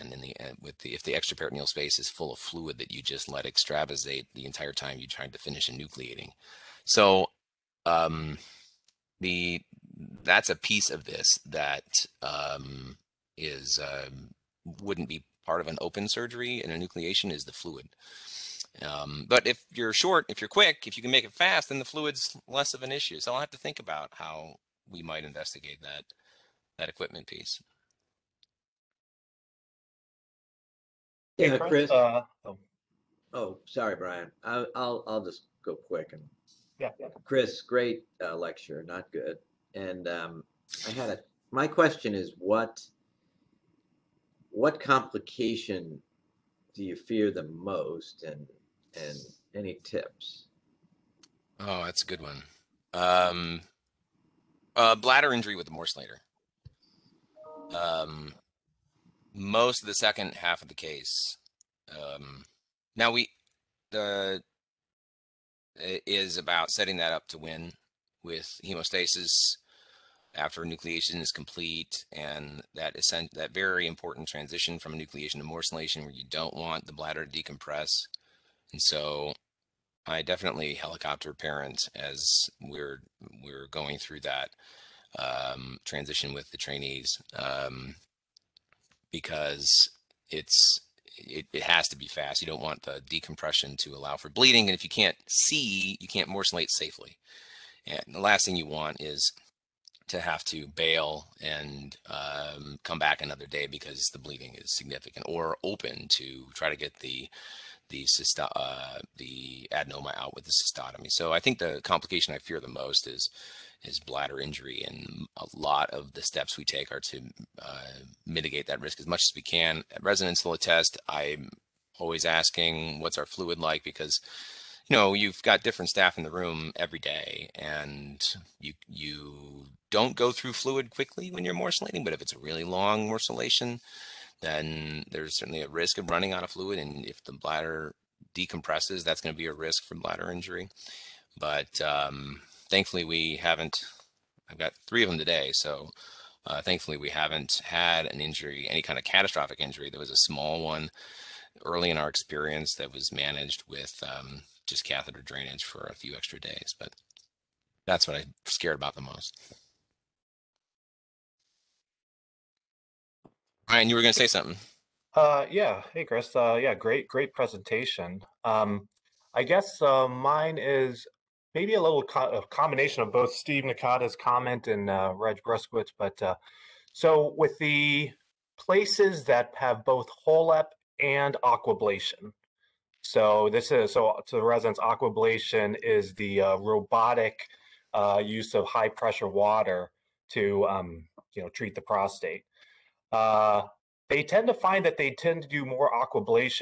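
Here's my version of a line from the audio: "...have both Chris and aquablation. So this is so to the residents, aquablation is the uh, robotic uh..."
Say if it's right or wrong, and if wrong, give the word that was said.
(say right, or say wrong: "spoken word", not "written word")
wrong: "HOLEP", not "Chris".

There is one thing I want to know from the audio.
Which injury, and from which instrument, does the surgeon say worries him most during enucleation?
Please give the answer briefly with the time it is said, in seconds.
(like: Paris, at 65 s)
Bladder injury with the morcellator, at 54 s.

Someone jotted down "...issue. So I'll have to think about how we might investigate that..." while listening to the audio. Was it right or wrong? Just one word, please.
right.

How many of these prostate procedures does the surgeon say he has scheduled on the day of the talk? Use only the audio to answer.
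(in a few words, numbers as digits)
3.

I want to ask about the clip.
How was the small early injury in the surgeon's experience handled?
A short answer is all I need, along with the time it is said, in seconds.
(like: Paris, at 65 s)
Catheter drainage, at 154 s.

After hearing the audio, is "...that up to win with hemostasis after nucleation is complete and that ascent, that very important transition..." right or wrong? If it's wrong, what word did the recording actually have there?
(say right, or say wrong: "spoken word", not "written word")
right.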